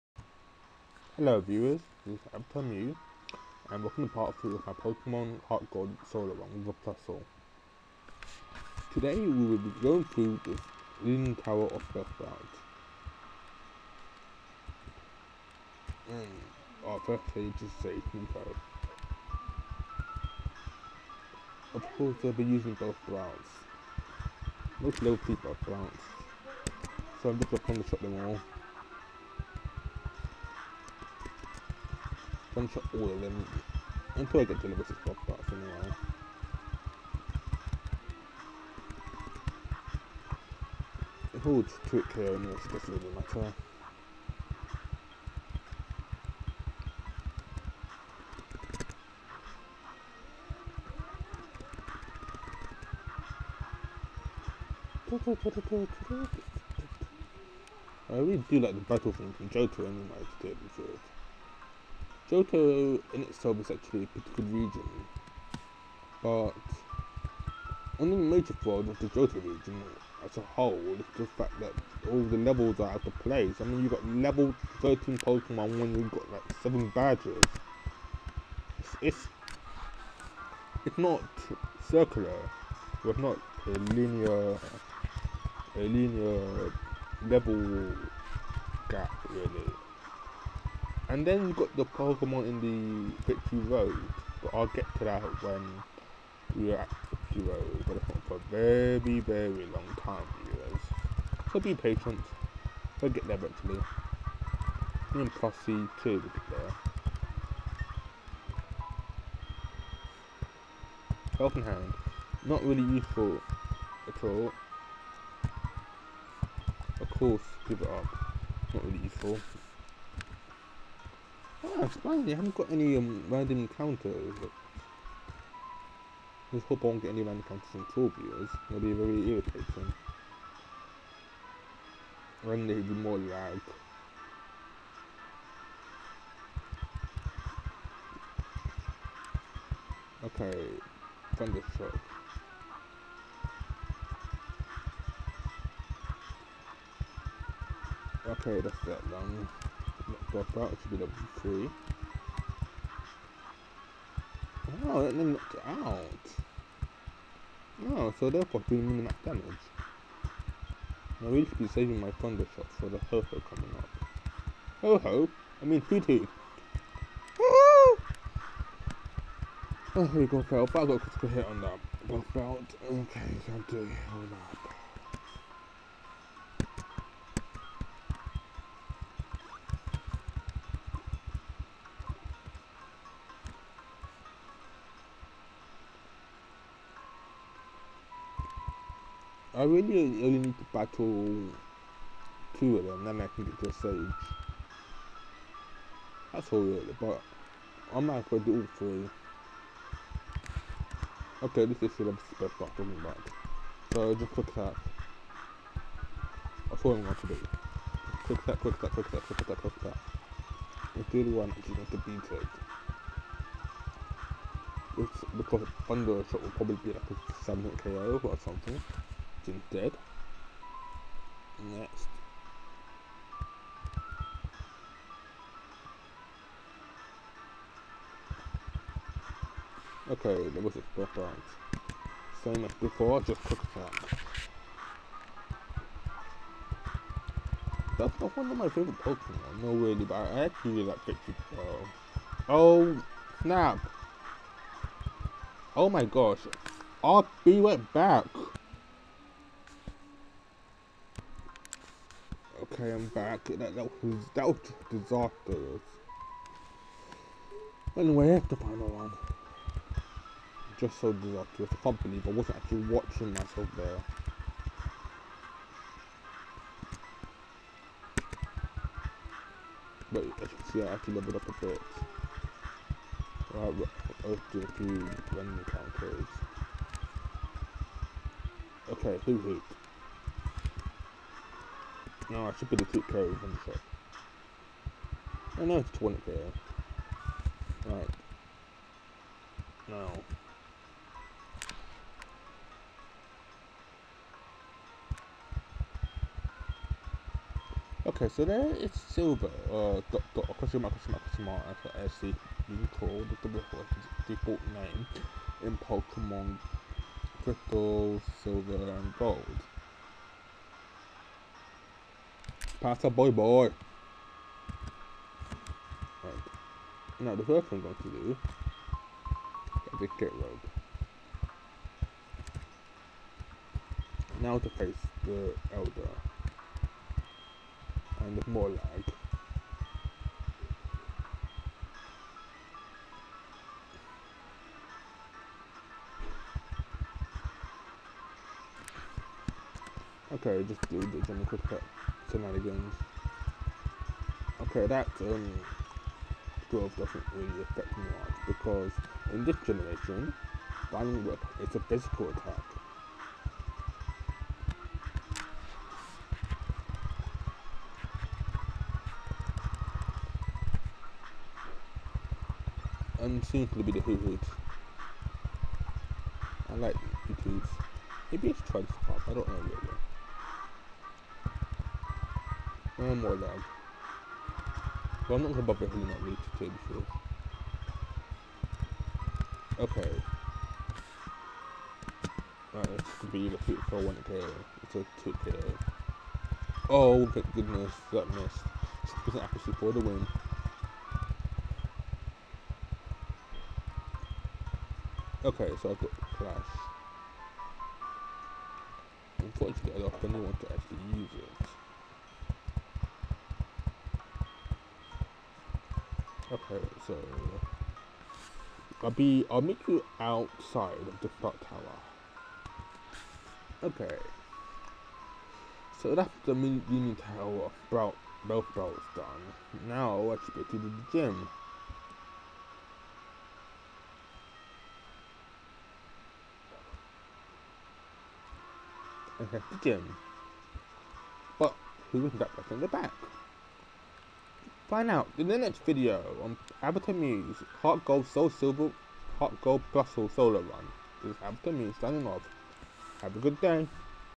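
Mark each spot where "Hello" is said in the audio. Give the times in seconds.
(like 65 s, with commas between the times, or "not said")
1 s.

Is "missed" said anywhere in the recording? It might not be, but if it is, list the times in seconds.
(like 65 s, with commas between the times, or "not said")
388 s.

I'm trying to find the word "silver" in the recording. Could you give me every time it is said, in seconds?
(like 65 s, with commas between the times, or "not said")
299 s, 308 s, 438 s.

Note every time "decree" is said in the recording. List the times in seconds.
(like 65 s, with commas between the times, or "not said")
not said.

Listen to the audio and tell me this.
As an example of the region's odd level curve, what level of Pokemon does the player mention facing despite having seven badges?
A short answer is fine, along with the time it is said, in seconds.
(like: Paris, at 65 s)
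13, at 74 s.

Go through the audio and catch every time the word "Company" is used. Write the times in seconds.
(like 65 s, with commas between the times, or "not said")
261 s.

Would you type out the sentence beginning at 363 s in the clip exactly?
And seems to be the Hoothoots.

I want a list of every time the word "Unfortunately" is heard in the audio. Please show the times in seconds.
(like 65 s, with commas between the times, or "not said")
399 s.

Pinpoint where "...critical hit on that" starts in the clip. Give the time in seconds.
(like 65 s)
171 s.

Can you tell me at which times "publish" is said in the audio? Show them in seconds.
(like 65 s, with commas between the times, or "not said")
not said.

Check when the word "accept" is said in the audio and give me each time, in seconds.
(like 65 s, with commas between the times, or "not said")
not said.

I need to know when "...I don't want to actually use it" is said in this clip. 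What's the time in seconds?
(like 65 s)
399 s.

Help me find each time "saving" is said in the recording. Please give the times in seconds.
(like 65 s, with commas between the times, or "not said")
161 s.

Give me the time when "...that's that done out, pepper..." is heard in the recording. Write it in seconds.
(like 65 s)
148 s.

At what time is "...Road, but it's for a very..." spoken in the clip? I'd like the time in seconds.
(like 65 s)
97 s.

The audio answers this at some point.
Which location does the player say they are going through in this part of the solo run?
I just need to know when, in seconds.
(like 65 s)
11 s.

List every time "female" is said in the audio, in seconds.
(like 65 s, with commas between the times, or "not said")
not said.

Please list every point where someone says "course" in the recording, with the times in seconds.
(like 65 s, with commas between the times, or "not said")
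21 s, 117 s.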